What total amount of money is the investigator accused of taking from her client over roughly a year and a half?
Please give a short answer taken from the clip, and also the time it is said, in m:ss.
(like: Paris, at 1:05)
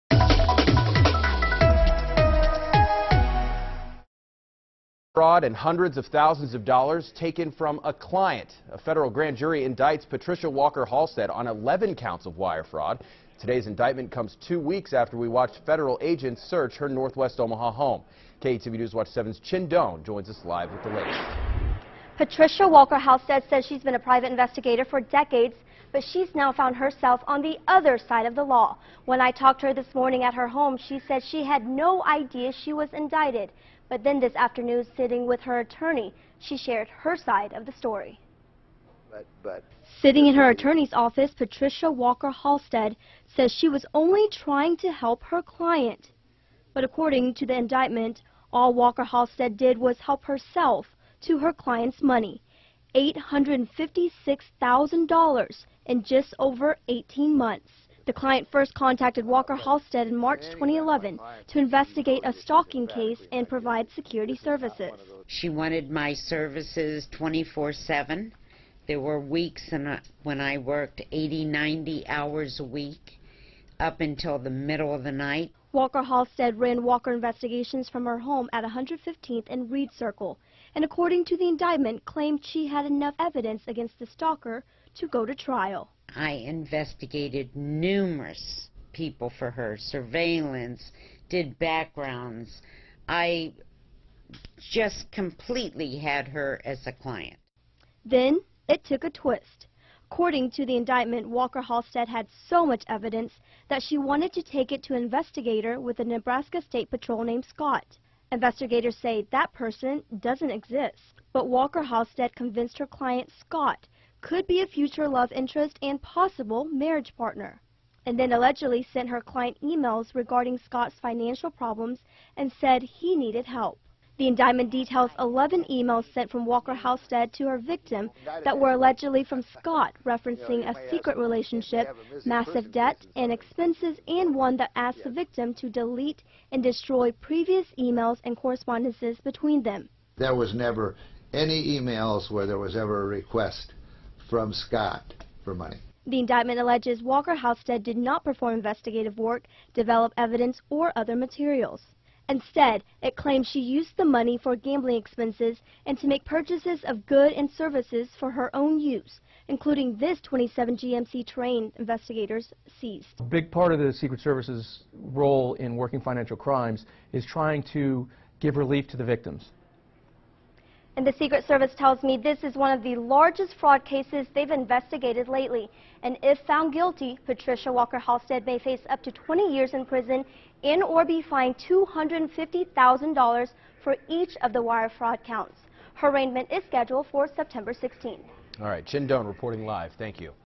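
$856,000, at 0:52.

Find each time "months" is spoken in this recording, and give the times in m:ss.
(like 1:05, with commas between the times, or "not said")
0:57.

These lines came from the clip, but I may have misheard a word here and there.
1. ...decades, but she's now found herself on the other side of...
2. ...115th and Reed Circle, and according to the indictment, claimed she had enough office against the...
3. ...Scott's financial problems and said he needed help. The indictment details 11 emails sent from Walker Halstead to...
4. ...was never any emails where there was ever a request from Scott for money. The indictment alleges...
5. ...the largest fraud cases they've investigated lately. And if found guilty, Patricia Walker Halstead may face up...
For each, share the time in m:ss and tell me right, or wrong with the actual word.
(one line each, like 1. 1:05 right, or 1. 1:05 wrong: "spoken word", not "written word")
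1. 0:24 right
2. 1:18 wrong: "evidence", not "office"
3. 2:00 right
4. 2:20 right
5. 2:52 right.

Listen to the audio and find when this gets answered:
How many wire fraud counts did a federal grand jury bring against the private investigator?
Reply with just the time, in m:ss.
0:11.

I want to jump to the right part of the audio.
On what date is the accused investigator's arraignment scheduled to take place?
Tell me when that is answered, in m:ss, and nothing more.
3:07.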